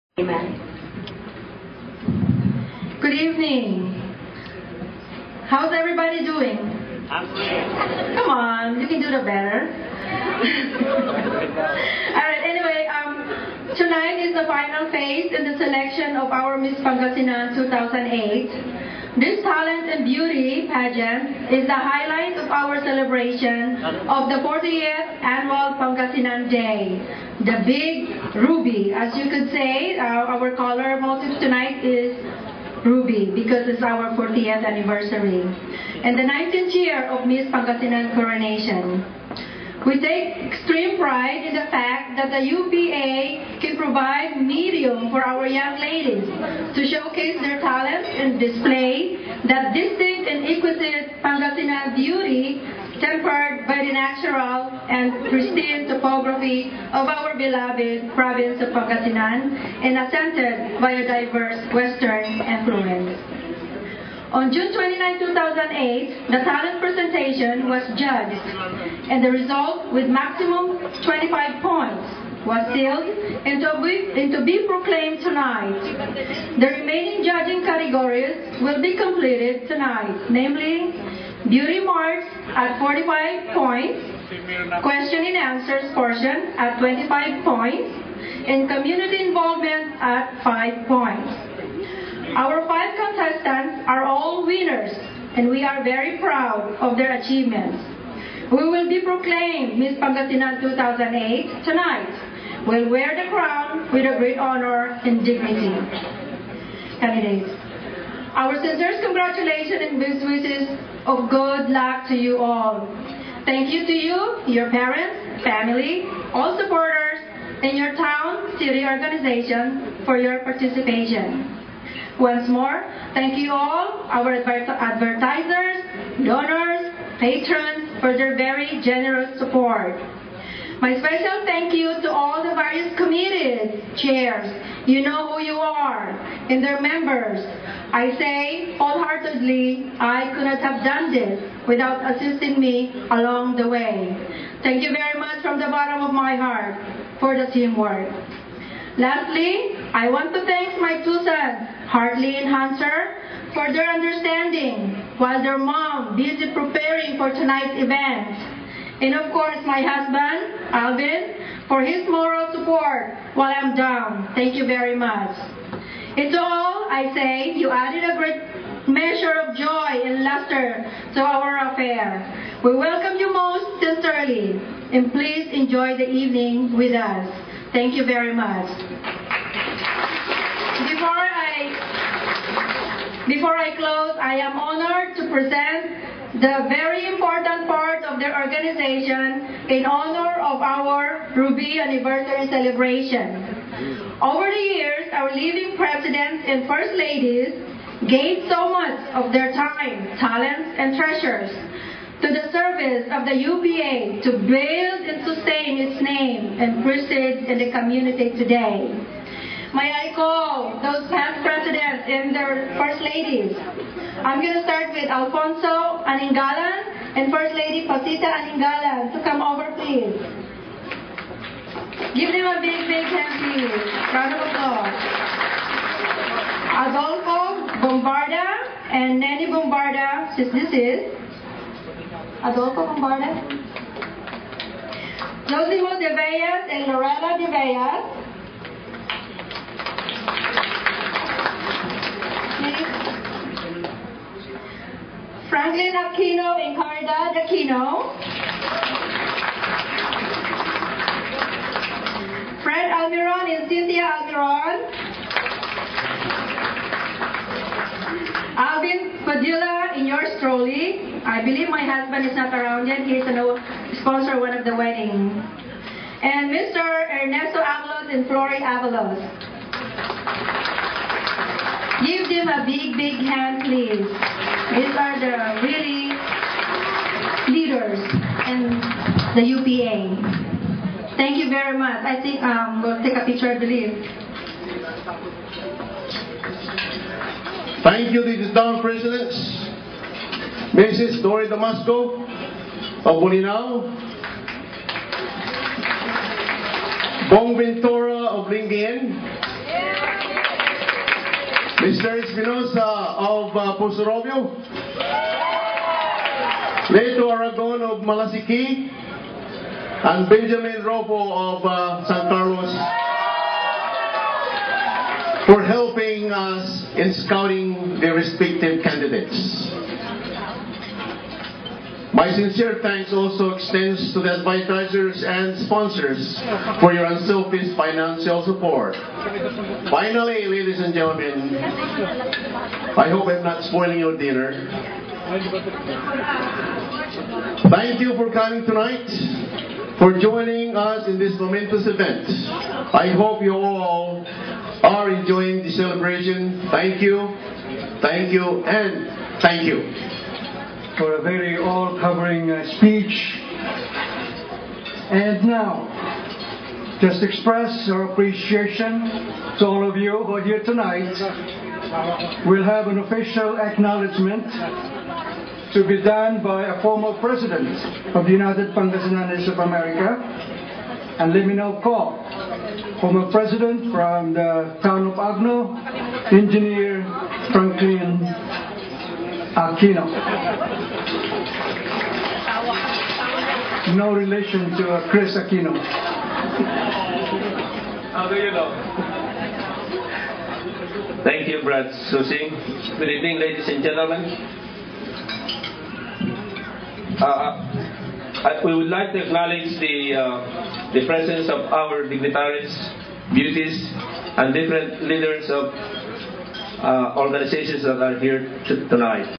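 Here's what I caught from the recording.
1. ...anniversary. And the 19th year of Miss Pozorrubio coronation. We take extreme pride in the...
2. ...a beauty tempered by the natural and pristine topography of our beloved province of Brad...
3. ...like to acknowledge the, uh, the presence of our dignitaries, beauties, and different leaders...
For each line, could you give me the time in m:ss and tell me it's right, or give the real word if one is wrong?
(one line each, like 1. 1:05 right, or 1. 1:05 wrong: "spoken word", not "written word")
1. 0:34 wrong: "Pangasinan", not "Pozorrubio"
2. 0:51 wrong: "Pangasinan", not "Brad"
3. 6:38 right.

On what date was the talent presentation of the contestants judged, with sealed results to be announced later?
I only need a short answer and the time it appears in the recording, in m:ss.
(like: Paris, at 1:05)
June 29, 2008, at 1:04.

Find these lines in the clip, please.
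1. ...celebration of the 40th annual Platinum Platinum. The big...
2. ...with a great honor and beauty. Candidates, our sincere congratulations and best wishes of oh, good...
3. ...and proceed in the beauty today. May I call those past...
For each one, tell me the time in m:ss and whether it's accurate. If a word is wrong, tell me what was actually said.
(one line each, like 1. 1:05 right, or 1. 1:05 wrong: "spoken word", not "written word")
1. 0:22 wrong: "Day", not "Platinum"
2. 1:43 wrong: "dignity", not "beauty"
3. 3:26 wrong: "community", not "beauty".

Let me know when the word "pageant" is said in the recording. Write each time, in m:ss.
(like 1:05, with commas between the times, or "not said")
0:20.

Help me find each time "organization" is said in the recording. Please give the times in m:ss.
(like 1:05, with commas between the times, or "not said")
1:58, 3:08, 6:47.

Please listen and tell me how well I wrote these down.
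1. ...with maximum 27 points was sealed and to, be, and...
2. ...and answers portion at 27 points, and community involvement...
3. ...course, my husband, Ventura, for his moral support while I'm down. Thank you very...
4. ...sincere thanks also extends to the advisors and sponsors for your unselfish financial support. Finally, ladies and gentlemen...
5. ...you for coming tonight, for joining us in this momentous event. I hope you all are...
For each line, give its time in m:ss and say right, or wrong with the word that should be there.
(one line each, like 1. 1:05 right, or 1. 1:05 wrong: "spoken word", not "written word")
1. 1:09 wrong: "25", not "27"
2. 1:25 wrong: "25", not "27"
3. 2:39 wrong: "Alvin", not "Ventura"
4. 5:22 right
5. 5:38 right.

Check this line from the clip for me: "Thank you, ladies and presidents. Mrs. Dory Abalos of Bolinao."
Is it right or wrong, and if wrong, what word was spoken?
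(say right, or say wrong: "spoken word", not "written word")
wrong: "Damasco", not "Abalos".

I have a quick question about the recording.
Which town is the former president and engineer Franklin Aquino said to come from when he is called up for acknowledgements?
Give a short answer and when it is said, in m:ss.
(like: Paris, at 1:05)
Agno, at 6:15.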